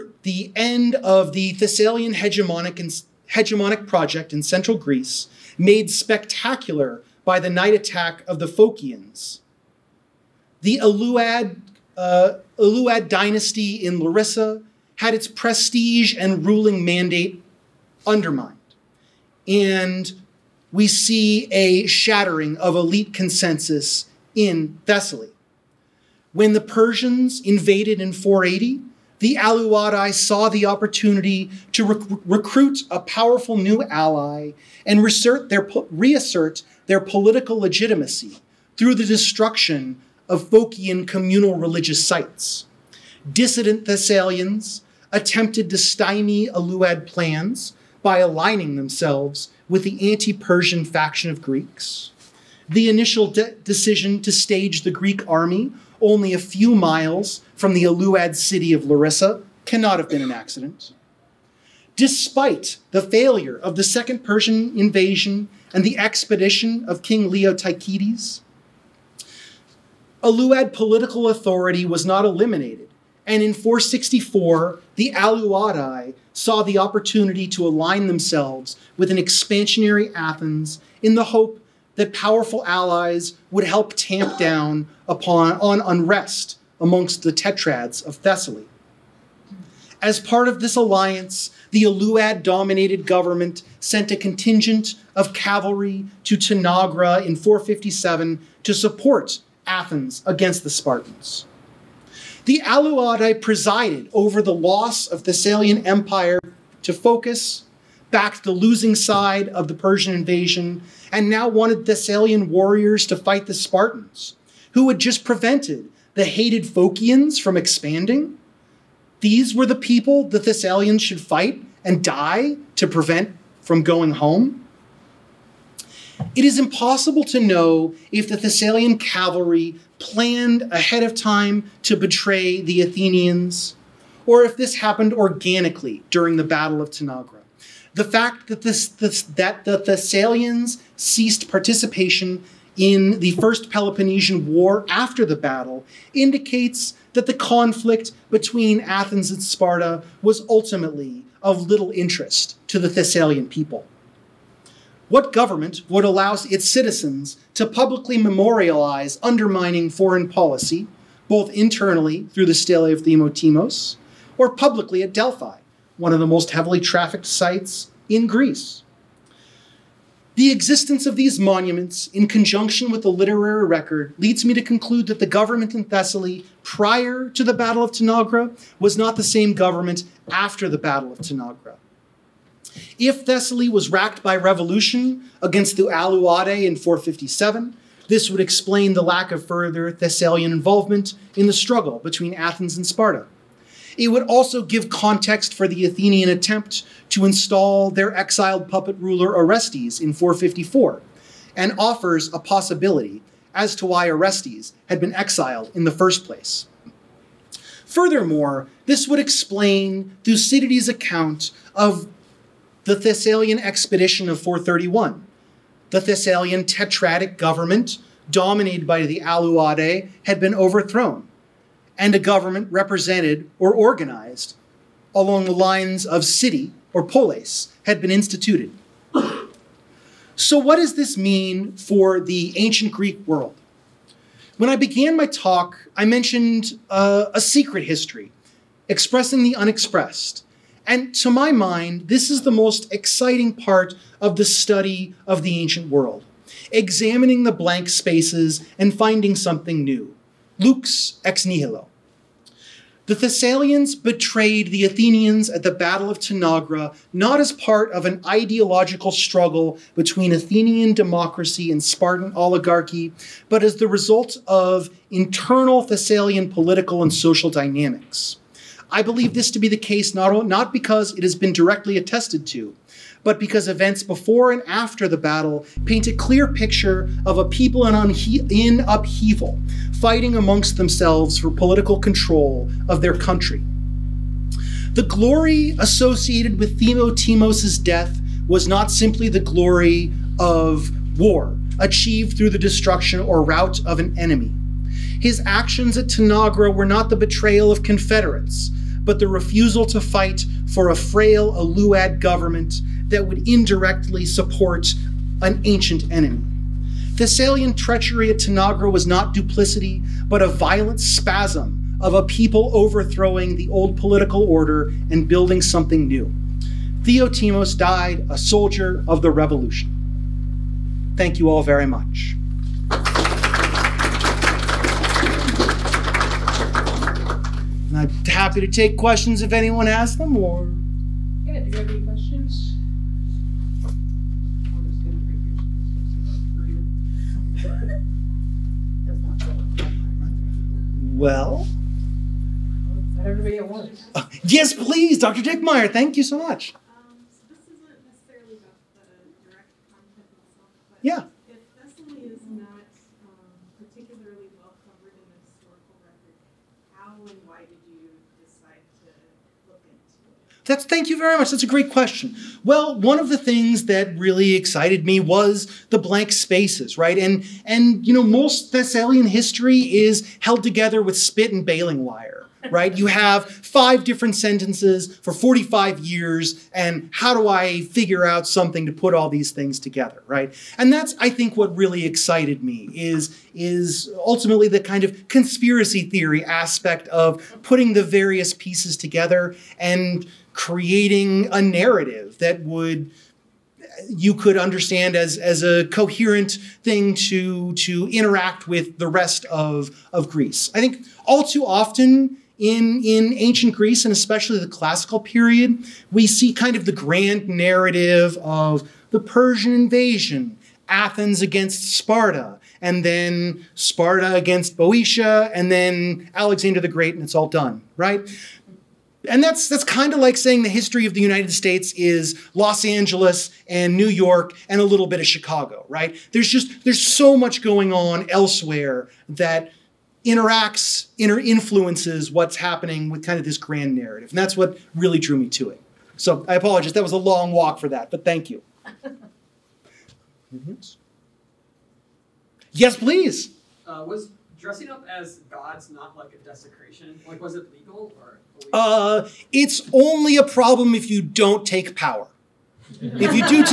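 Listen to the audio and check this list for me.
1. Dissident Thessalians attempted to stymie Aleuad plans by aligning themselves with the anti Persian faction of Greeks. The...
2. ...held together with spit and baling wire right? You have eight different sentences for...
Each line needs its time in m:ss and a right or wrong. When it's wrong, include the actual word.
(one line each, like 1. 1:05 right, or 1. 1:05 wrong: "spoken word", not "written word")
1. 0:43 right
2. 6:10 wrong: "five", not "eight".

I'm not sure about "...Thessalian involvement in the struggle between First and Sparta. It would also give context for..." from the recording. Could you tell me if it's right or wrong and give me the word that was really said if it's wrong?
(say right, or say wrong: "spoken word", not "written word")
wrong: "Athens", not "First".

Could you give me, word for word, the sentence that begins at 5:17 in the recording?
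Theotimos died a soldier of the revolution.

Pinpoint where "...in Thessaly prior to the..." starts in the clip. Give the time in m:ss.
2:55.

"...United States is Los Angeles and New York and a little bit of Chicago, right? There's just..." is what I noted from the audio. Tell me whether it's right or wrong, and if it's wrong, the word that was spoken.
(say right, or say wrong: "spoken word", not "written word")
right.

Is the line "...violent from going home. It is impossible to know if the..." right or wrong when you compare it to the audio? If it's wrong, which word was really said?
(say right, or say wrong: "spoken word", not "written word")
wrong: "prevent", not "violent".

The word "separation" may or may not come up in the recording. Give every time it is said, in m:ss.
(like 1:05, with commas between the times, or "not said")
not said.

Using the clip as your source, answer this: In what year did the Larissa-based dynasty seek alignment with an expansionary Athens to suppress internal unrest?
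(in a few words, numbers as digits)
464.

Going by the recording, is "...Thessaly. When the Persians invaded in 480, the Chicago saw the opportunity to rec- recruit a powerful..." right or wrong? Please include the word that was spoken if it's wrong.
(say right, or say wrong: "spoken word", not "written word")
wrong: "Aleuadae", not "Chicago".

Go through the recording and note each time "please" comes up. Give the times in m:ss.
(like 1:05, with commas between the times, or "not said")
5:44, 7:22.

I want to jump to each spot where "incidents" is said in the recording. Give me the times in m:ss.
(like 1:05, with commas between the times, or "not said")
not said.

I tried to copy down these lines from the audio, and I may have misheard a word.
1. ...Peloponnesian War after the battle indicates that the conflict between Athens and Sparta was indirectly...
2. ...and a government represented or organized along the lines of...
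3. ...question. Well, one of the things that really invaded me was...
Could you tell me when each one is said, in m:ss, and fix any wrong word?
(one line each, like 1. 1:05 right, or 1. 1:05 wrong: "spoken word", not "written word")
1. 2:23 wrong: "ultimately", not "indirectly"
2. 3:41 right
3. 6:01 wrong: "excited", not "invaded".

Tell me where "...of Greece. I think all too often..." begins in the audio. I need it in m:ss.
6:40.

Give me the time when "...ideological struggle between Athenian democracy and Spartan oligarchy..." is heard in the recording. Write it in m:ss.
4:18.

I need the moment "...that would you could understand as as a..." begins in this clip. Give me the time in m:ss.
6:32.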